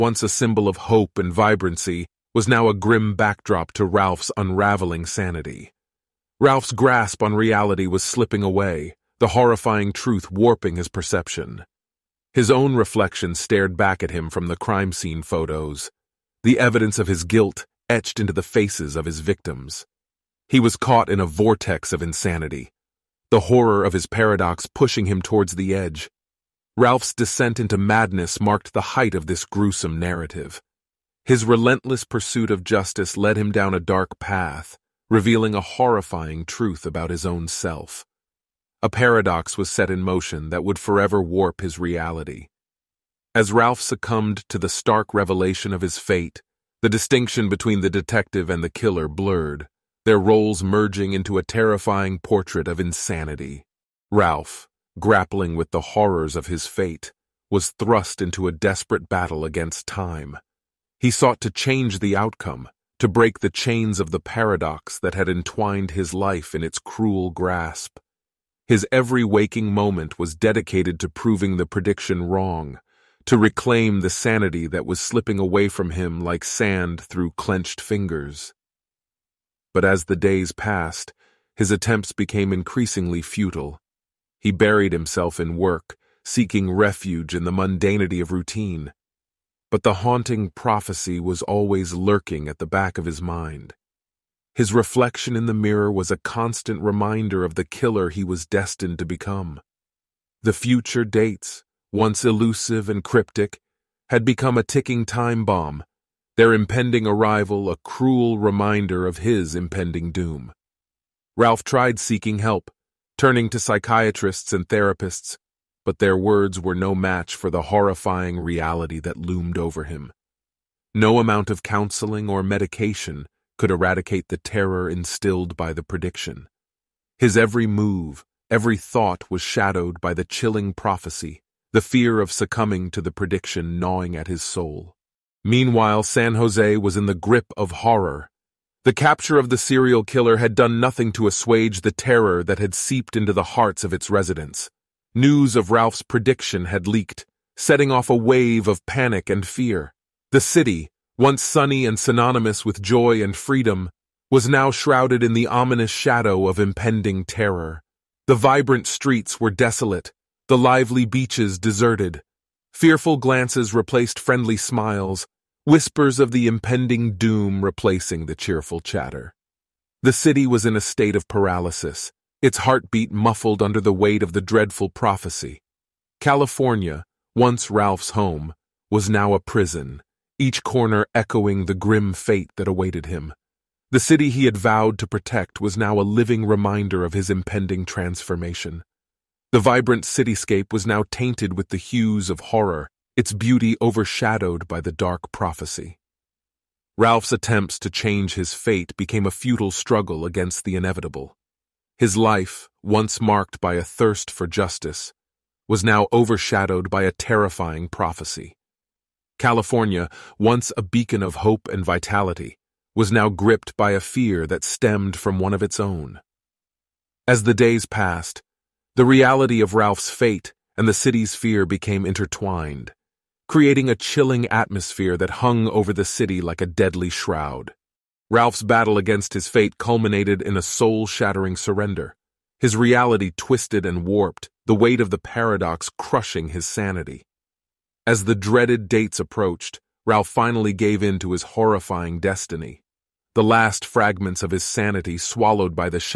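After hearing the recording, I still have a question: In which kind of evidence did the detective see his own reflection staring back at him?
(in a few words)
crime scene photos.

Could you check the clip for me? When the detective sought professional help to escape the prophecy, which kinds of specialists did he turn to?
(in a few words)
psychiatrists and therapists.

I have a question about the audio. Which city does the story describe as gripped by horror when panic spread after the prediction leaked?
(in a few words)
San Jose.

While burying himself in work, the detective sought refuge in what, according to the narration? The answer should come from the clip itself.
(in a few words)
the mundanity of routine.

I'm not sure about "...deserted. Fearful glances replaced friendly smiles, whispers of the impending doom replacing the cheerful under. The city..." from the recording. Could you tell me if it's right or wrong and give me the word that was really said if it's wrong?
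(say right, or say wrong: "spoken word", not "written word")
wrong: "chatter", not "under".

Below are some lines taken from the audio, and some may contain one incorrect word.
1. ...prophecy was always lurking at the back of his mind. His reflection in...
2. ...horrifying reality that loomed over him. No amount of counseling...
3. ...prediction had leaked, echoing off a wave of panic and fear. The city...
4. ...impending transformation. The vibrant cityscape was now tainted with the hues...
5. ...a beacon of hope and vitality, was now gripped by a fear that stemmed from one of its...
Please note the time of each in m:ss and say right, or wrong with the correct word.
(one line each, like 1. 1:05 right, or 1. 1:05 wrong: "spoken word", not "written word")
1. 1:30 right
2. 1:57 right
3. 2:26 wrong: "setting", not "echoing"
4. 3:07 right
5. 3:30 right.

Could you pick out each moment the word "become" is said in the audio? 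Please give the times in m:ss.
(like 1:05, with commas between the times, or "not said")
1:39, 1:44.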